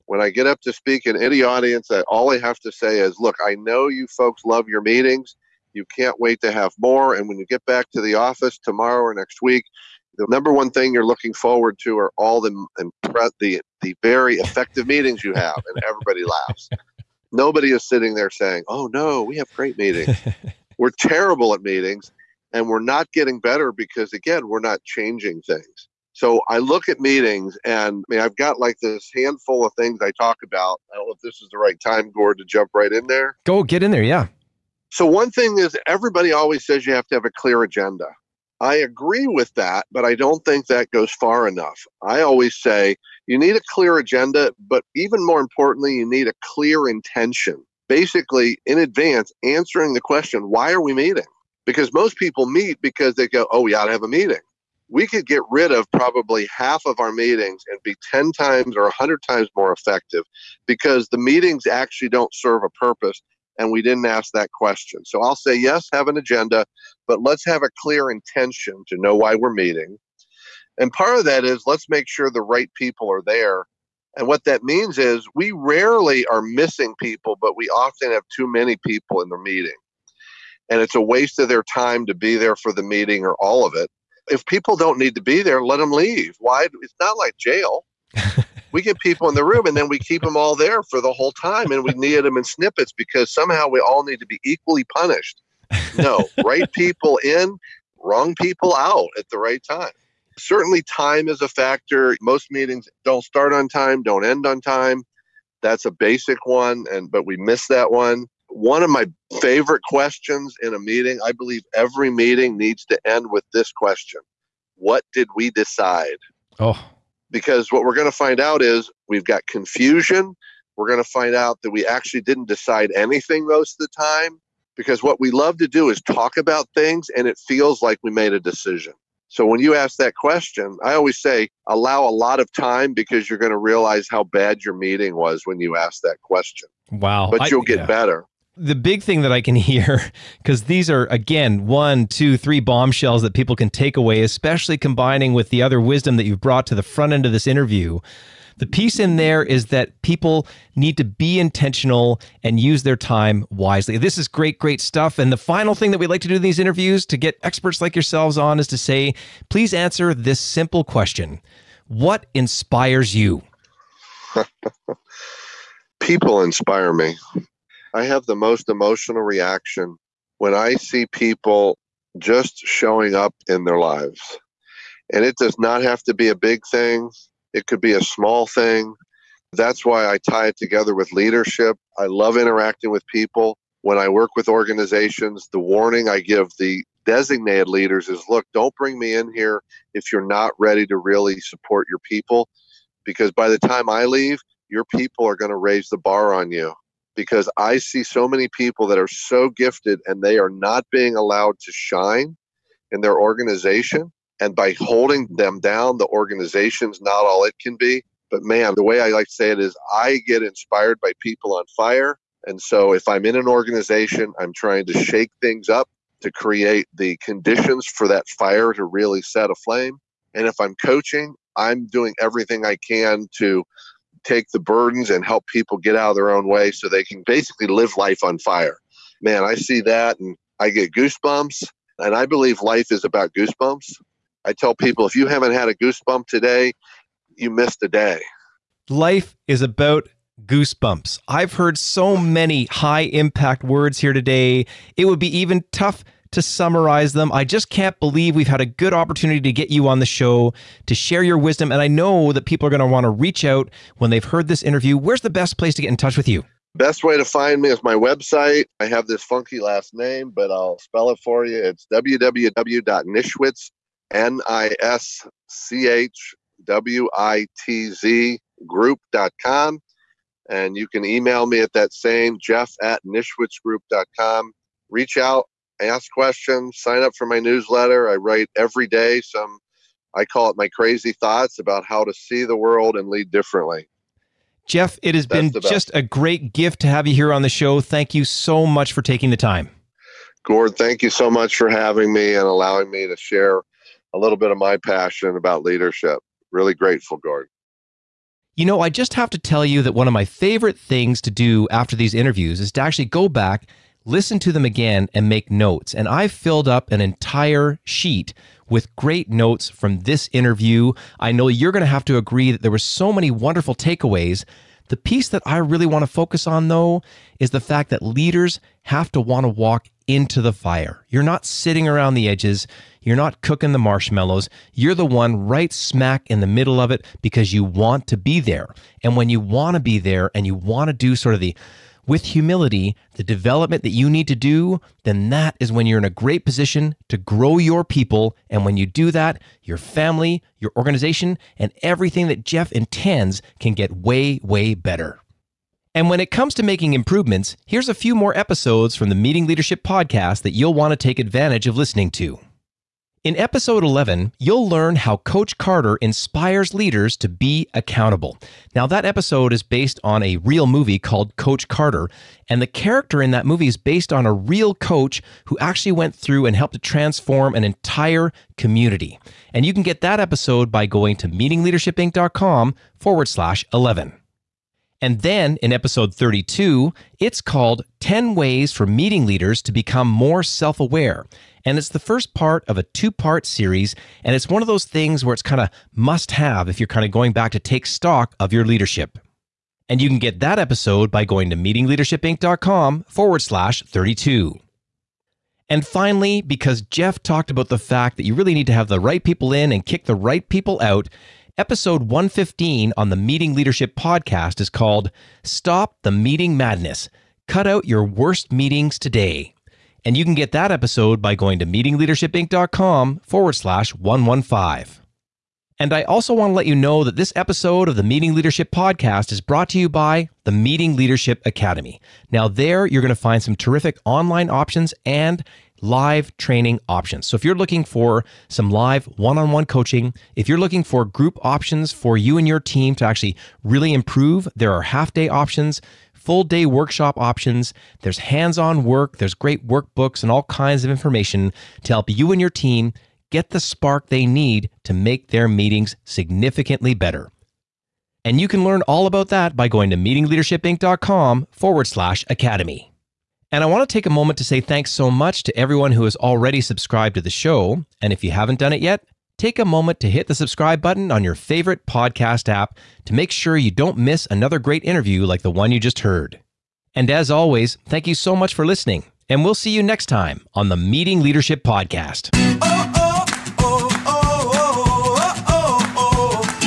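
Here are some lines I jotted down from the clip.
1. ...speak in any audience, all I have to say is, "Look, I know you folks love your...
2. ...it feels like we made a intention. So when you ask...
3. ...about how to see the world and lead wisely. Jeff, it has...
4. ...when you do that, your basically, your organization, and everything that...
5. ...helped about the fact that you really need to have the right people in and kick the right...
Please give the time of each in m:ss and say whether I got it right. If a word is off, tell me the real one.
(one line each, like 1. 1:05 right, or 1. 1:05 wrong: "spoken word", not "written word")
1. 0:00 right
2. 2:07 wrong: "decision", not "intention"
3. 4:41 wrong: "differently", not "wisely"
4. 5:38 wrong: "family", not "basically"
5. 6:37 wrong: "talked", not "helped".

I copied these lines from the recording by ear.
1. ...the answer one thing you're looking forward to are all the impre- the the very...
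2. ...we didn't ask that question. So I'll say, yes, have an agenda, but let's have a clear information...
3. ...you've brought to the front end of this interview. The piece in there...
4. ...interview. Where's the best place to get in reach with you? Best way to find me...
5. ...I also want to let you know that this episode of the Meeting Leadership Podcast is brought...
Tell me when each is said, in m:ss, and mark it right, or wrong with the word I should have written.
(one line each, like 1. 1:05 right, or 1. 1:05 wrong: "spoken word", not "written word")
1. 0:10 wrong: "number", not "answer"
2. 1:03 wrong: "intention", not "information"
3. 2:26 right
4. 4:14 wrong: "touch", not "reach"
5. 6:55 right.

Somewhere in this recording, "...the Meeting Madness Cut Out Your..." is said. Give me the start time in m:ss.
6:46.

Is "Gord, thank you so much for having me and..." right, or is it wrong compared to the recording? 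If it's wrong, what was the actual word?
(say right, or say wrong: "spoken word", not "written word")
right.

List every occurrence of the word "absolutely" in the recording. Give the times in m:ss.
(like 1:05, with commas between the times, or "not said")
not said.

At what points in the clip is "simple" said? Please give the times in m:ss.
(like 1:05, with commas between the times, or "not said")
2:40.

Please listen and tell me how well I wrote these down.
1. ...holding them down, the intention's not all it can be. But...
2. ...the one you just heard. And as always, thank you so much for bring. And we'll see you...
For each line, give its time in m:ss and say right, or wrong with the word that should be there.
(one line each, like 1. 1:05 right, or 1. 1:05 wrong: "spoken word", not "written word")
1. 3:24 wrong: "organization", not "intention"
2. 7:45 wrong: "listening", not "bring".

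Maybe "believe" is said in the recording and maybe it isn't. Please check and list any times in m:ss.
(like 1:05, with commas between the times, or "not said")
1:51, 3:52, 4:07.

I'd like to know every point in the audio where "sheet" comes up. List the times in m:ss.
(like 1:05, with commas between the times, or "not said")
5:07.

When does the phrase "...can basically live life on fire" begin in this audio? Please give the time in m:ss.
3:47.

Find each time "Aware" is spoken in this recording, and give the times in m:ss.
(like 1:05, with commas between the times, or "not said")
6:20.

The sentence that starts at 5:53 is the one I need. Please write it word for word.
In episode 11, you'll learn how Coach Carter inspires leaders to be accountable.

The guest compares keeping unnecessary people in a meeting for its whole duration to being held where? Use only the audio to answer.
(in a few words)
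jail.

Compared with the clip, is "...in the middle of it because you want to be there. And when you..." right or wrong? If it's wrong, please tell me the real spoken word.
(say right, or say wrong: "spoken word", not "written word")
right.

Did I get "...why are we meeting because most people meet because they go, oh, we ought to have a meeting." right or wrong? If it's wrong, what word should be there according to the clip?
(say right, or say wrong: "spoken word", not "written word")
right.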